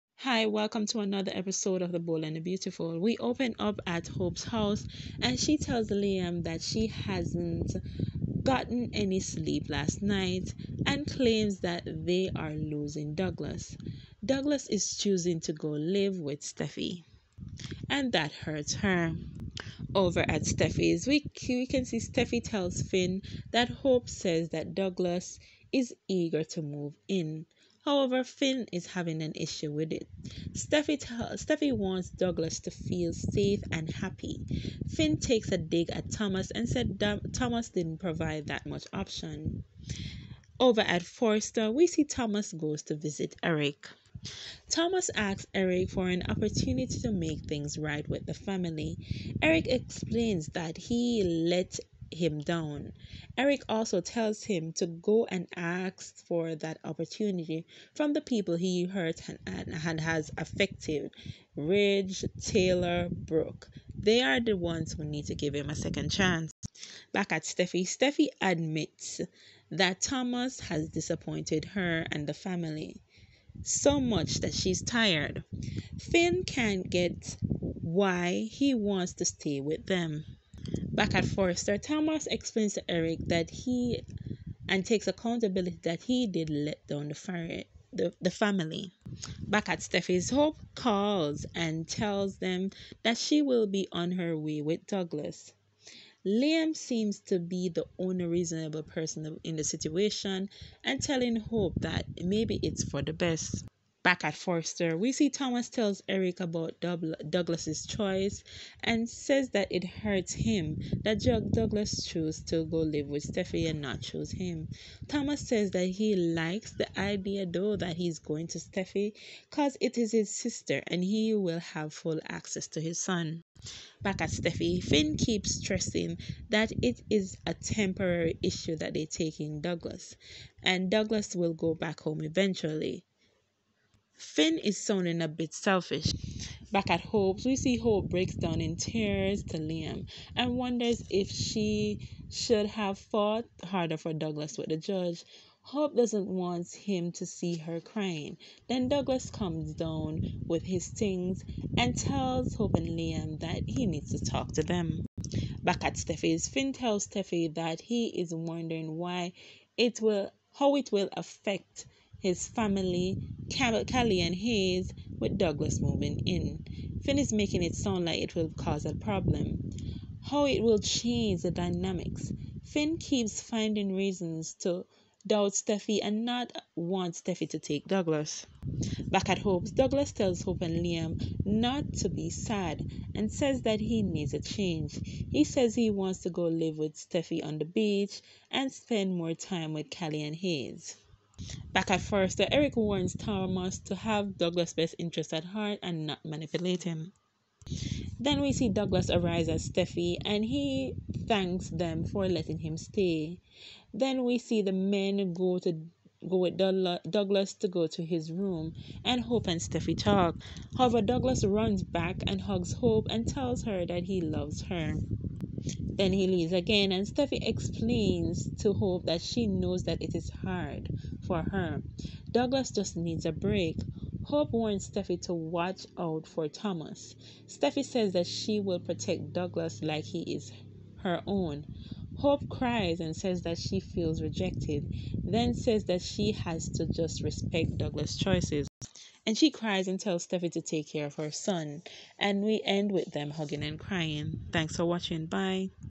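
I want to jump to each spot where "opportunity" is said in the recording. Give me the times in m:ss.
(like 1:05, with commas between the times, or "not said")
0:46, 0:56.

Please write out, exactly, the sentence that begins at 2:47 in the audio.
Finn is making it sound like it will cause a problem.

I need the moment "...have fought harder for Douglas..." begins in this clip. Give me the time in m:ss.
2:22.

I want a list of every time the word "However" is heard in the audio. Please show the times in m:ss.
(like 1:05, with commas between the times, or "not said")
0:27, 3:30.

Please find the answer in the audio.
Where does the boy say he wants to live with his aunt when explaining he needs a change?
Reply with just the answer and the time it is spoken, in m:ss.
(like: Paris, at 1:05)
on the beach, at 3:07.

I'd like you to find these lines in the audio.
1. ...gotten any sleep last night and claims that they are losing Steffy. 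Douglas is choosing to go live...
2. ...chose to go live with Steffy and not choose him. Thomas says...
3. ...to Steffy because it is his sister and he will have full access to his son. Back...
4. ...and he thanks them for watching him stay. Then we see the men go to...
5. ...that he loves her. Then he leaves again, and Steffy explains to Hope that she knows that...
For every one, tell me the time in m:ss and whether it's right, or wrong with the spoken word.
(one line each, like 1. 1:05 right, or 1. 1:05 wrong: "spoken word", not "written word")
1. 0:08 wrong: "Douglas", not "Steffy"
2. 1:52 right
3. 1:58 right
4. 3:20 wrong: "letting", not "watching"
5. 3:33 right.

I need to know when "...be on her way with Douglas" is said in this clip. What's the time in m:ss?
1:33.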